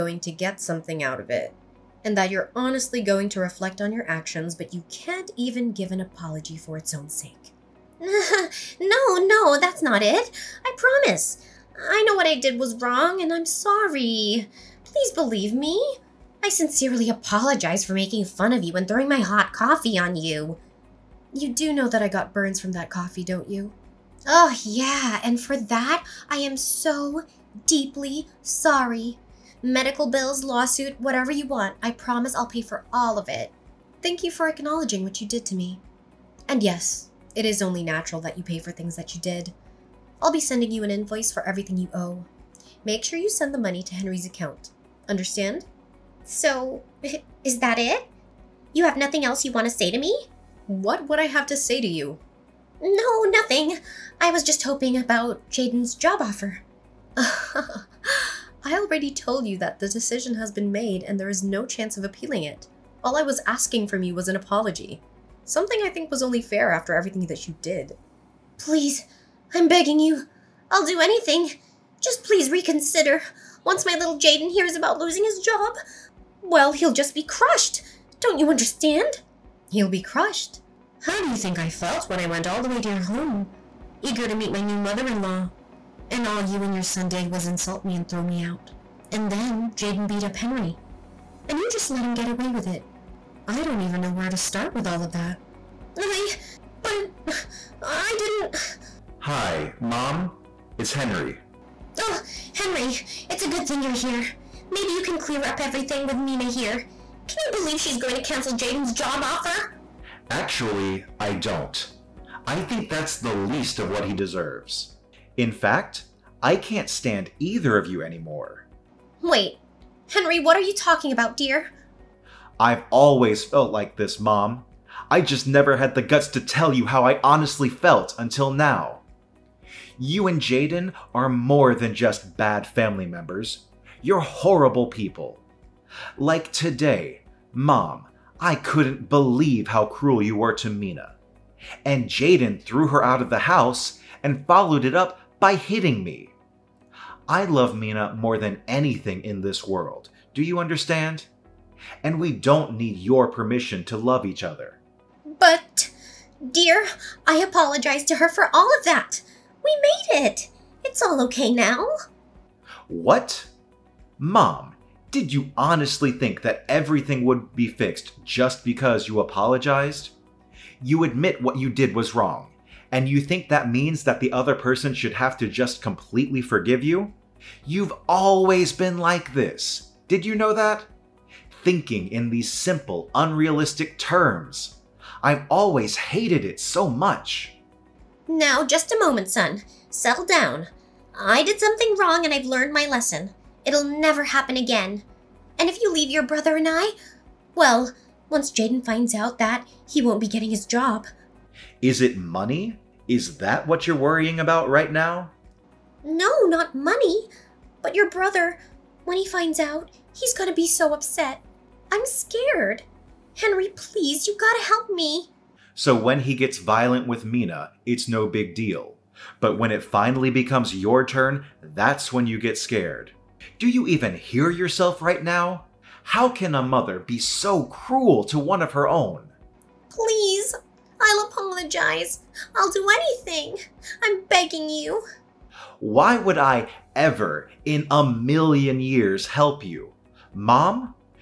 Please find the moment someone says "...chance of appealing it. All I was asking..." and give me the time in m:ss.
1:01.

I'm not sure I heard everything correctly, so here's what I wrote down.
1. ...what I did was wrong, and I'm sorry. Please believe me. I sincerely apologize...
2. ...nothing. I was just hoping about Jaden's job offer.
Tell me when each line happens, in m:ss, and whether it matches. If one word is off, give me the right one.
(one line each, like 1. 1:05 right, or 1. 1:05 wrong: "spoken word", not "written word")
1. 0:12 right
2. 0:53 right.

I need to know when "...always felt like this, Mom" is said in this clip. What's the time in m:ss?
2:02.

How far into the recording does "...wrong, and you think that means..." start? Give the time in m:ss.
2:52.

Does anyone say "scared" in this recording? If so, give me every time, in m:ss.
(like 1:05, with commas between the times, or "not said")
3:32, 3:42.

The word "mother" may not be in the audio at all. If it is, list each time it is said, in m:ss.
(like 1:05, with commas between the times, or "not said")
1:24, 3:46.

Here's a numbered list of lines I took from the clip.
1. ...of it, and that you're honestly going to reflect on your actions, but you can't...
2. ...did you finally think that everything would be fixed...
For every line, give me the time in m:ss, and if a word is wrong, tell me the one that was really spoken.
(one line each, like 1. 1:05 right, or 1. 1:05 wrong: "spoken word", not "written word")
1. 0:01 right
2. 2:45 wrong: "honestly", not "finally".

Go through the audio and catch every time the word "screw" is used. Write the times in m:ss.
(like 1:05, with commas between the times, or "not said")
not said.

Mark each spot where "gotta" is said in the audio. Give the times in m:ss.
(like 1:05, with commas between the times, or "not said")
3:34.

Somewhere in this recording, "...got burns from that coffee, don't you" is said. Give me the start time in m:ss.
0:22.